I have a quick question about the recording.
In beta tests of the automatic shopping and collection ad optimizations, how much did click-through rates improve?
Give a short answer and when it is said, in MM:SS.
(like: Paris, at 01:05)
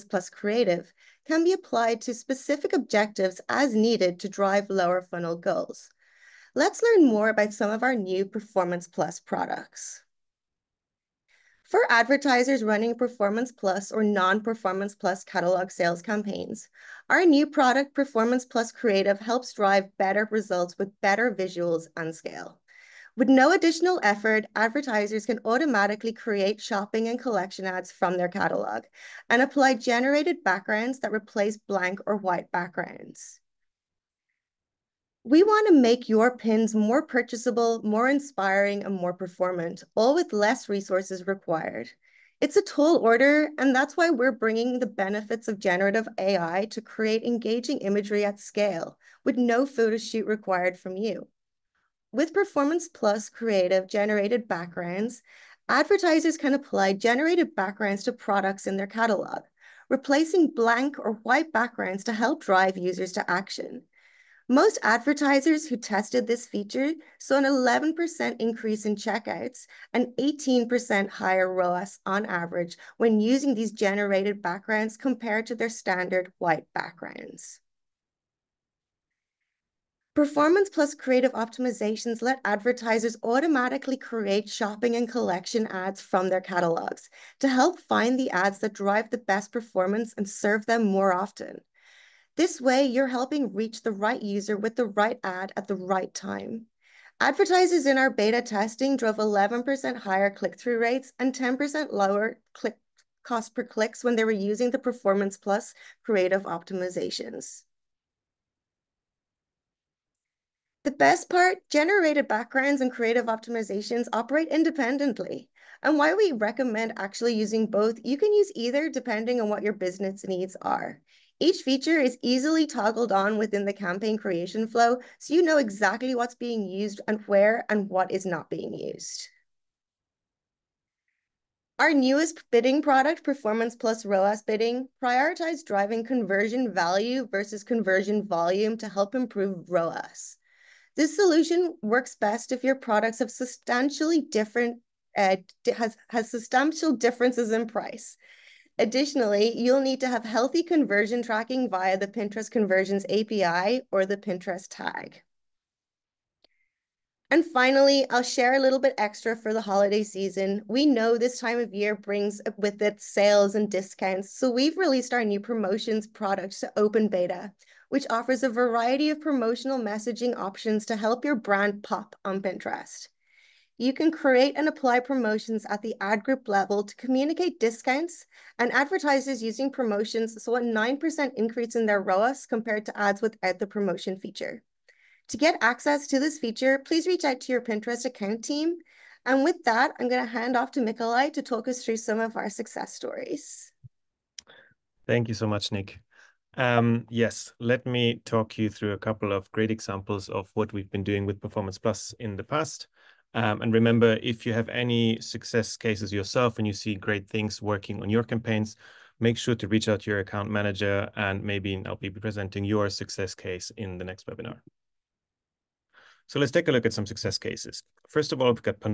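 11%, at 01:39.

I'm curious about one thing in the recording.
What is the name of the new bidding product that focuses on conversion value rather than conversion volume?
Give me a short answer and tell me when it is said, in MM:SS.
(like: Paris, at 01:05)
Performance Plus ROAS Bidding, at 02:13.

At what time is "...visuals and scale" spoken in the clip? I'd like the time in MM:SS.
00:21.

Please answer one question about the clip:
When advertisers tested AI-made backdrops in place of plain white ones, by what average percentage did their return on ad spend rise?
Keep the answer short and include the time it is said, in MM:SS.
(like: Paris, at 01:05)
18%, at 01:10.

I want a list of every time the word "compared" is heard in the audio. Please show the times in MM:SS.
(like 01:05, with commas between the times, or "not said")
01:14, 03:02.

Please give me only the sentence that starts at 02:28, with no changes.
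Additionally, you'll need to have healthy conversion tracking via the Pinterest Conversions API or the Pinterest tag.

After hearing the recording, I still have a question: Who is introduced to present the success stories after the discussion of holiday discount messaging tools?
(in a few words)
Nikolai.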